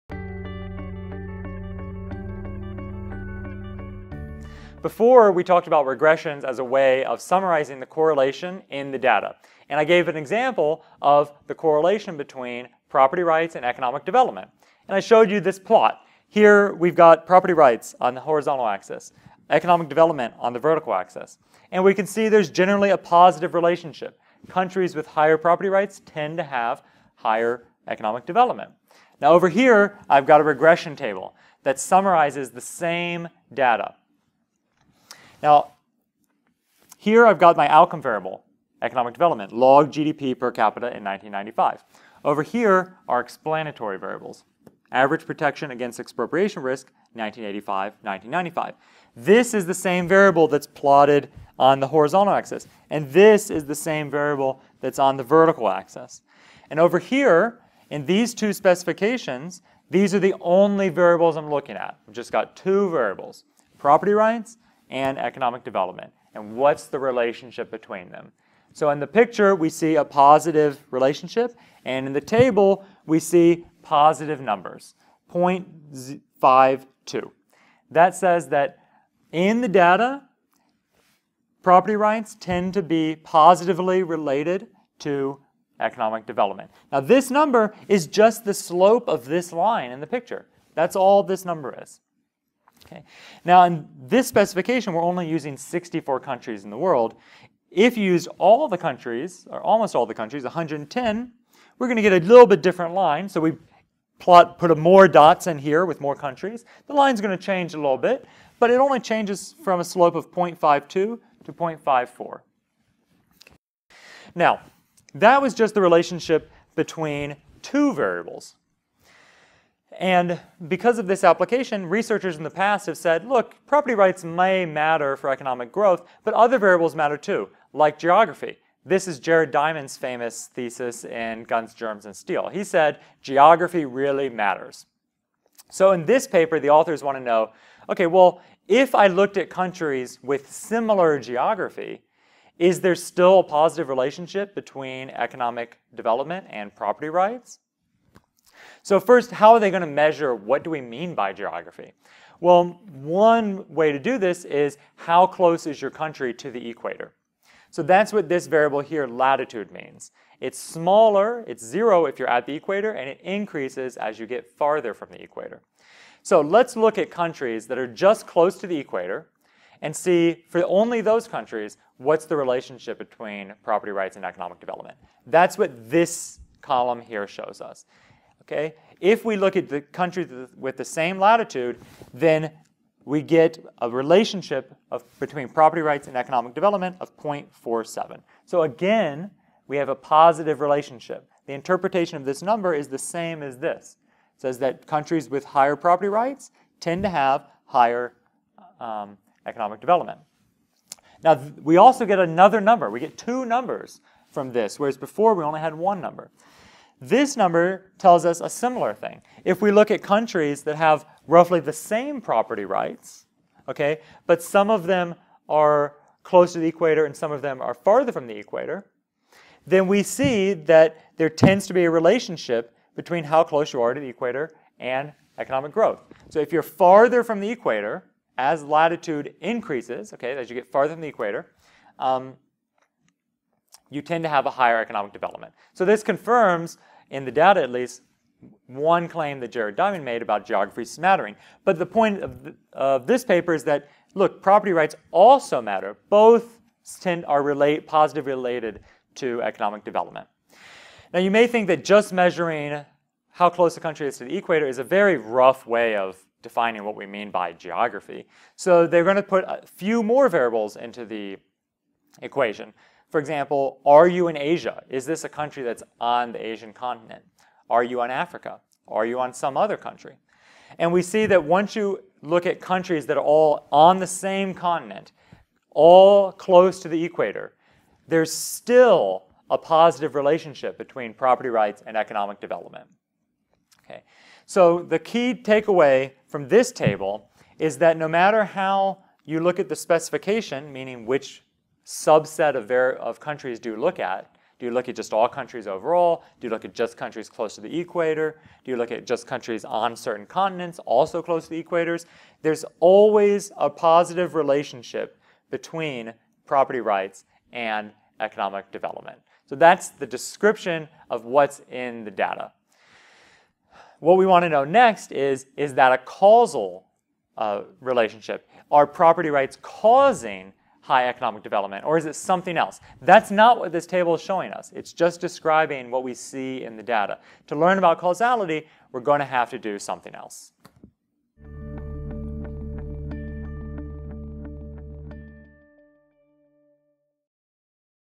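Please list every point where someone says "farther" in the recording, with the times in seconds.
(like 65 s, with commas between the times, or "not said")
164 s, 217 s, 226 s, 230 s.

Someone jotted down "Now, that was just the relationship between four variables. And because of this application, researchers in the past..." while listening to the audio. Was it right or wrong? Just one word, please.
wrong.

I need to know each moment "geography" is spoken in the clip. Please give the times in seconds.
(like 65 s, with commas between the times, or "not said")
127 s, 133 s, 141 s, 151 s, 240 s, 257 s.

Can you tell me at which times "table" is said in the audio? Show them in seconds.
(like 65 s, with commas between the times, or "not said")
30 s, 72 s, 286 s, 323 s.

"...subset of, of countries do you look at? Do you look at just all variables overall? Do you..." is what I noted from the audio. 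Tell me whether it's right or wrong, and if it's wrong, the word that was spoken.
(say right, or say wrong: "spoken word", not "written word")
wrong: "countries", not "variables".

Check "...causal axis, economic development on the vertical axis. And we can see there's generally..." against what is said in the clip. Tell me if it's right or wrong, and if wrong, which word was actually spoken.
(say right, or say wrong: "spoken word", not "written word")
wrong: "horizontal", not "causal".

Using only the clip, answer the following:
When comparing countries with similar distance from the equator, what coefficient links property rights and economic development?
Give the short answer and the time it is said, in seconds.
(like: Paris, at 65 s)
0.47, at 187 s.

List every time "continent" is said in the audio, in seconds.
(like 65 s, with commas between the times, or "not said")
266 s, 274 s, 300 s.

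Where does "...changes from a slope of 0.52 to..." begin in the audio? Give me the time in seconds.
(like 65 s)
108 s.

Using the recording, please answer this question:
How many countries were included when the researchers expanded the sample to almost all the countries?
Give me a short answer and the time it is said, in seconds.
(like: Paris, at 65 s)
110, at 100 s.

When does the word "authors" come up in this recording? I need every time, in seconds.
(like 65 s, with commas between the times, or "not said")
136 s.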